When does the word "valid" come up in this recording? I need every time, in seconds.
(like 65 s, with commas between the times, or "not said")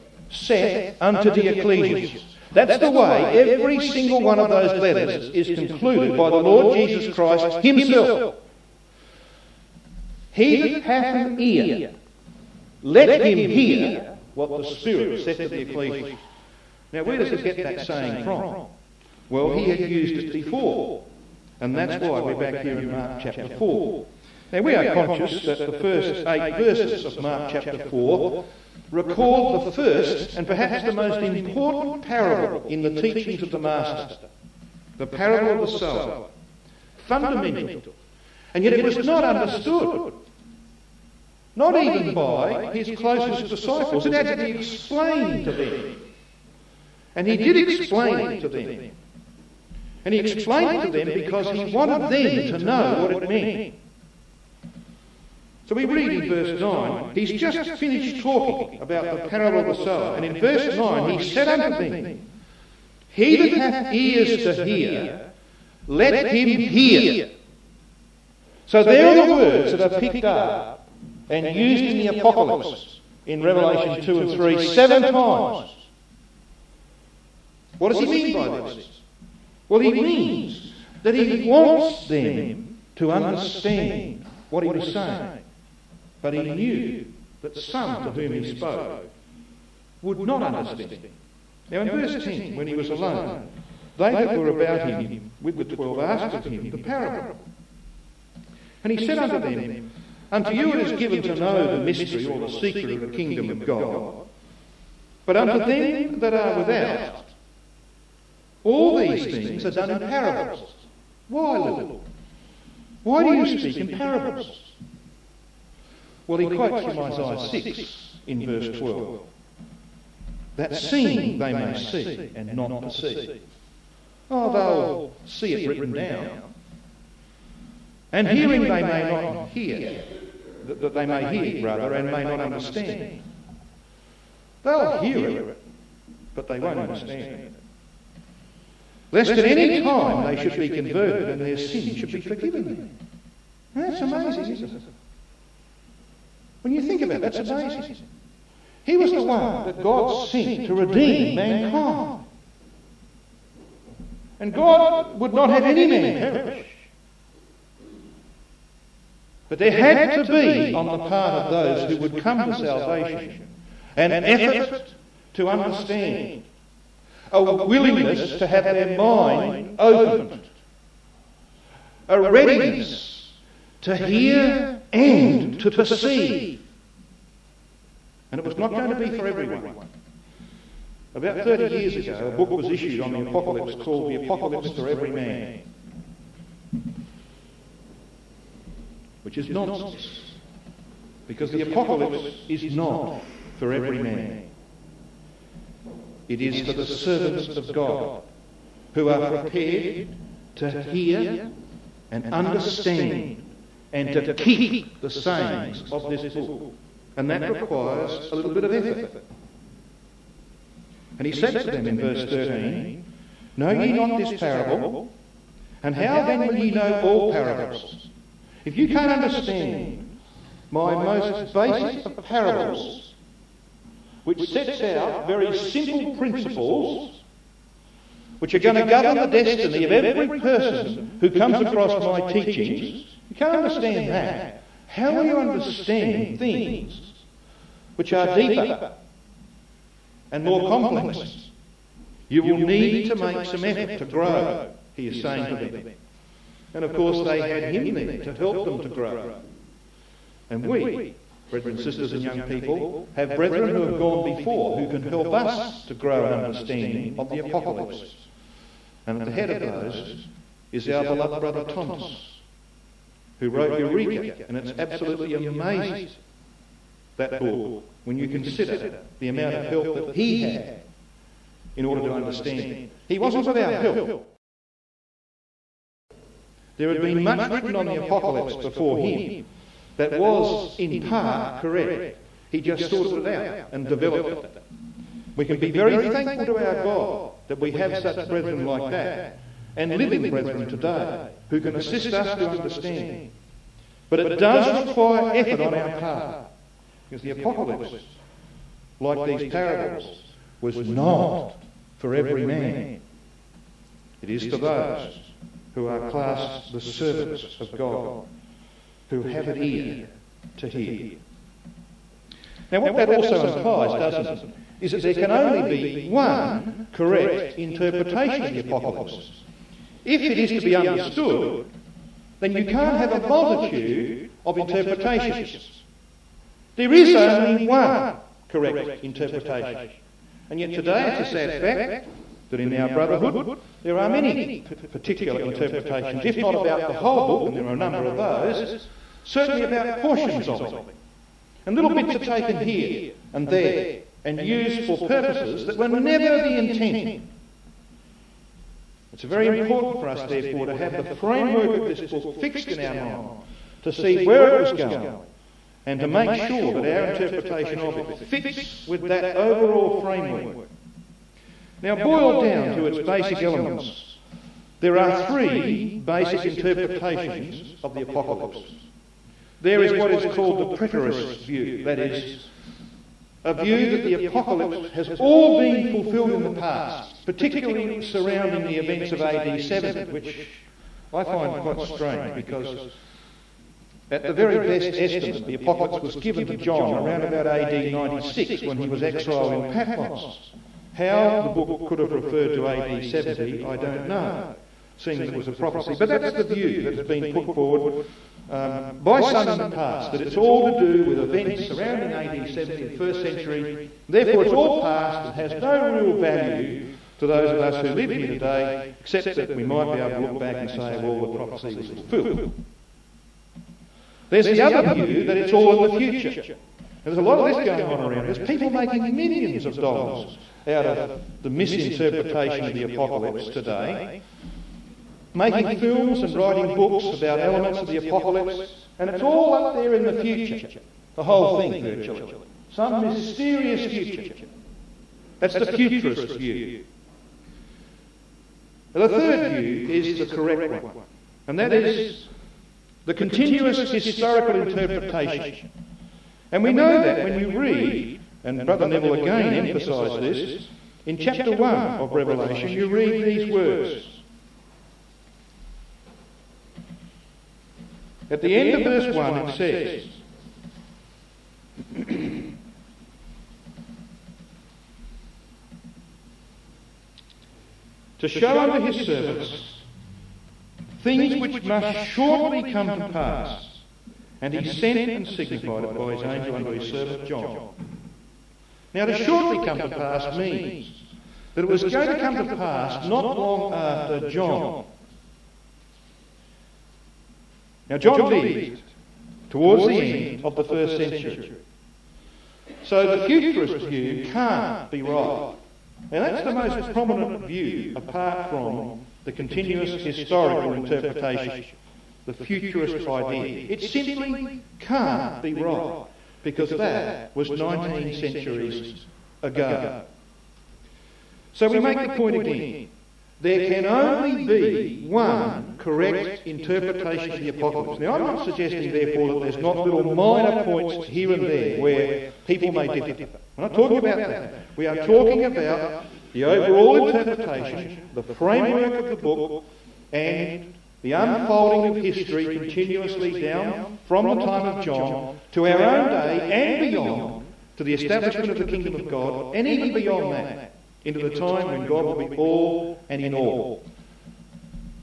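not said.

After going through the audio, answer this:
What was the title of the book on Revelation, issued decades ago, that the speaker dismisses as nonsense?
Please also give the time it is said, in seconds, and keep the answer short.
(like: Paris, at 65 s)
The Apocalypse for Every Man, at 184 s.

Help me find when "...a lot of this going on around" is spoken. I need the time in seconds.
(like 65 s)
417 s.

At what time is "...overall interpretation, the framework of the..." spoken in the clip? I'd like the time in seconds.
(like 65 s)
526 s.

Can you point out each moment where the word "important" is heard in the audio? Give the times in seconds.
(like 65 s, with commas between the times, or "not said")
31 s, 349 s.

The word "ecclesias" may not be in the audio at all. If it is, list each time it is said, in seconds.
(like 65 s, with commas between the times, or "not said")
1 s, 15 s.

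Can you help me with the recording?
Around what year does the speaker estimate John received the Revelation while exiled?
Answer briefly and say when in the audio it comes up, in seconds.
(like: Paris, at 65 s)
AD 96, at 387 s.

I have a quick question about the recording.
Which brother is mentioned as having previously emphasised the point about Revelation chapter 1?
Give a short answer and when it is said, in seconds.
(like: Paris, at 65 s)
Neville, at 448 s.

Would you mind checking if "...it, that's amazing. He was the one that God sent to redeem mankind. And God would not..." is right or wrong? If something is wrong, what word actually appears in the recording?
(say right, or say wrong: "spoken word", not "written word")
right.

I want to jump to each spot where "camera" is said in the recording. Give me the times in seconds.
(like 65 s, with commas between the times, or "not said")
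not said.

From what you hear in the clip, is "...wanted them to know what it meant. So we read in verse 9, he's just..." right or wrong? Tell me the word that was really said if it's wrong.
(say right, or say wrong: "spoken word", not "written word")
right.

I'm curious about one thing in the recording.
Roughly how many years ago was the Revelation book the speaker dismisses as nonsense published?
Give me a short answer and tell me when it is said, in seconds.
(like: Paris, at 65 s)
30, at 181 s.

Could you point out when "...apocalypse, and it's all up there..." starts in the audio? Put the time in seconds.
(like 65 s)
427 s.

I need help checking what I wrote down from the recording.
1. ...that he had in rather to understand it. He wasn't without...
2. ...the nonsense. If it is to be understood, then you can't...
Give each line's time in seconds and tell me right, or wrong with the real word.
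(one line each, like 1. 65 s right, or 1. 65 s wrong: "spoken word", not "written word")
1. 269 s wrong: "order", not "rather"
2. 318 s wrong: "apocalypse", not "nonsense".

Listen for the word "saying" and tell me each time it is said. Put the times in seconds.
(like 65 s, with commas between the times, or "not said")
17 s, 84 s, 205 s, 245 s.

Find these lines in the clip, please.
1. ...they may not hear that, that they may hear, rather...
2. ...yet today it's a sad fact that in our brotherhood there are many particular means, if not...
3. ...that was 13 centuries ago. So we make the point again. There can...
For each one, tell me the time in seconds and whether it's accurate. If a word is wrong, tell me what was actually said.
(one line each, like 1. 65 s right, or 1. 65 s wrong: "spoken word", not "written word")
1. 128 s right
2. 330 s wrong: "interpretations", not "means"
3. 506 s wrong: "19", not "13".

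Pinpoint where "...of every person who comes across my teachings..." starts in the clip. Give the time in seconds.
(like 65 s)
229 s.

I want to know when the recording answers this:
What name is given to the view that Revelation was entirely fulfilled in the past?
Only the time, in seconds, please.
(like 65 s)
370 s.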